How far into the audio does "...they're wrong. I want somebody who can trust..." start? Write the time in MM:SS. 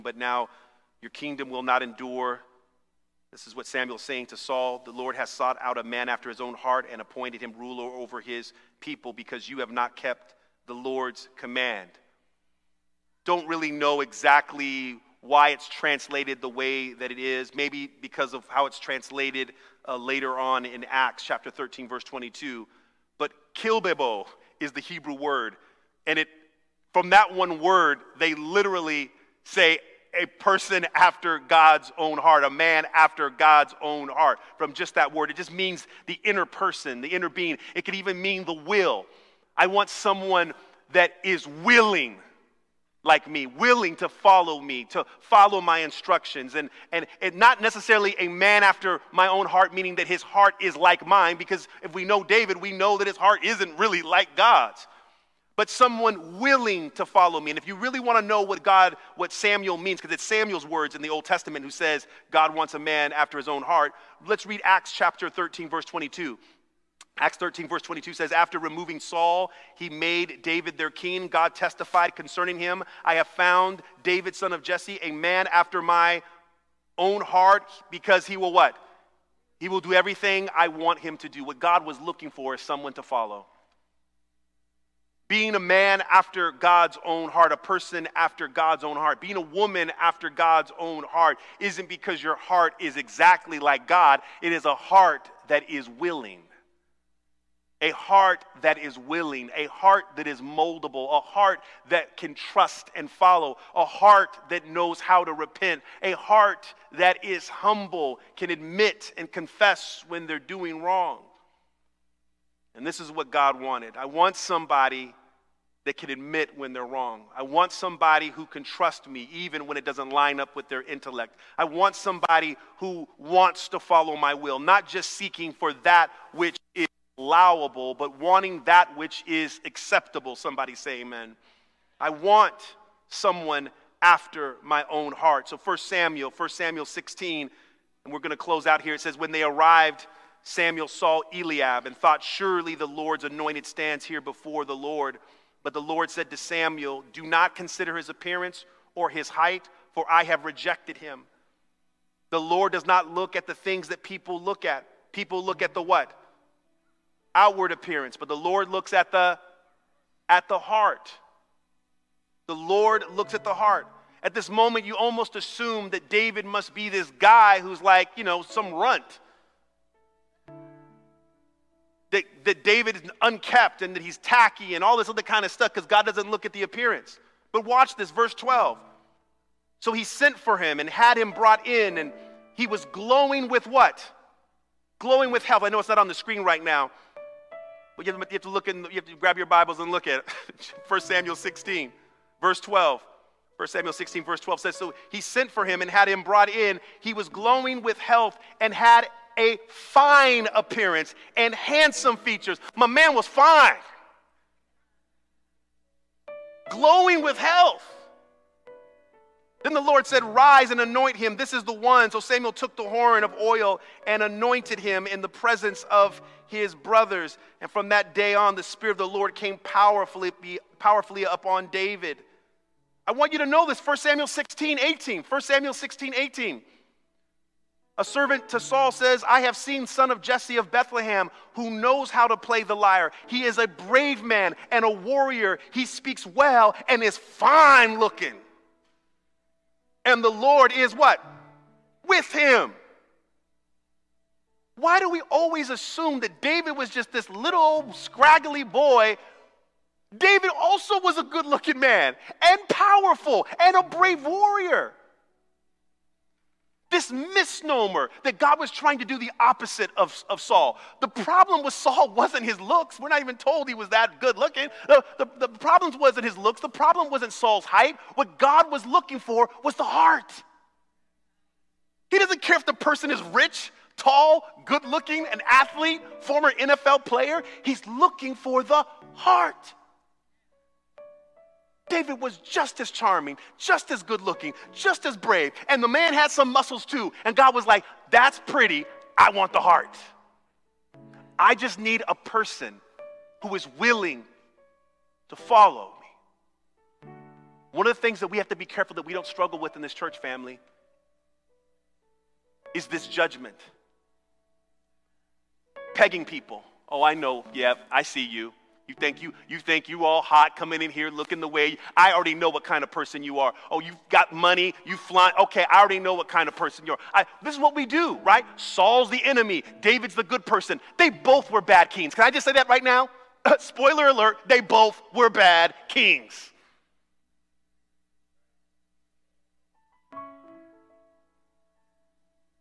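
01:56.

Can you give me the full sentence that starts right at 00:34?
From just that word, it just means the inner person, the inner being.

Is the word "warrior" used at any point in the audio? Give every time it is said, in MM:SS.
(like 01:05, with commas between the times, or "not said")
03:54, 04:14.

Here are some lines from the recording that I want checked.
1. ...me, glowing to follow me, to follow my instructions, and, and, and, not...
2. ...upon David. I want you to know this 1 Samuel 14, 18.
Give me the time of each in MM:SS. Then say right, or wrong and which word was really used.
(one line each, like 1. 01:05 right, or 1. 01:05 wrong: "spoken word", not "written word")
1. 00:43 wrong: "willing", not "glowing"
2. 03:41 wrong: "16", not "14".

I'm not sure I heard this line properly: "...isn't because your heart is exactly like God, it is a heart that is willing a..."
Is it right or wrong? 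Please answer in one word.
right.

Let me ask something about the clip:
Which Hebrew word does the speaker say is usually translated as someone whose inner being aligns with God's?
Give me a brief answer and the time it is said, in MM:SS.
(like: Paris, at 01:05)
Kilbebo, at 00:23.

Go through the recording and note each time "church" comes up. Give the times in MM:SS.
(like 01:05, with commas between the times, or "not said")
04:59.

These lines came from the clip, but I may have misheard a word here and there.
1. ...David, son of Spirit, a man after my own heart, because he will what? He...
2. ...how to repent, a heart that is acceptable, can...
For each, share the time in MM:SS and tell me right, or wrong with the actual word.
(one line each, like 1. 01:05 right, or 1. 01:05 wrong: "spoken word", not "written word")
1. 01:14 wrong: "Jesse", not "Spirit"
2. 01:45 wrong: "humble", not "acceptable".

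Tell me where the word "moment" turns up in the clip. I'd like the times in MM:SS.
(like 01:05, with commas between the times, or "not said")
02:44.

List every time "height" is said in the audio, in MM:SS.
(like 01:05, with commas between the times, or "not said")
02:29, 04:27.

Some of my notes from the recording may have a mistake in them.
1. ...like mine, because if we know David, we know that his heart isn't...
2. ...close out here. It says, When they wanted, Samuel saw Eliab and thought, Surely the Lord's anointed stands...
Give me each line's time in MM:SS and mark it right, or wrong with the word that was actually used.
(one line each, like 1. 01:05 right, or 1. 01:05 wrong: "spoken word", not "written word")
1. 00:50 right
2. 02:18 wrong: "arrived", not "wanted".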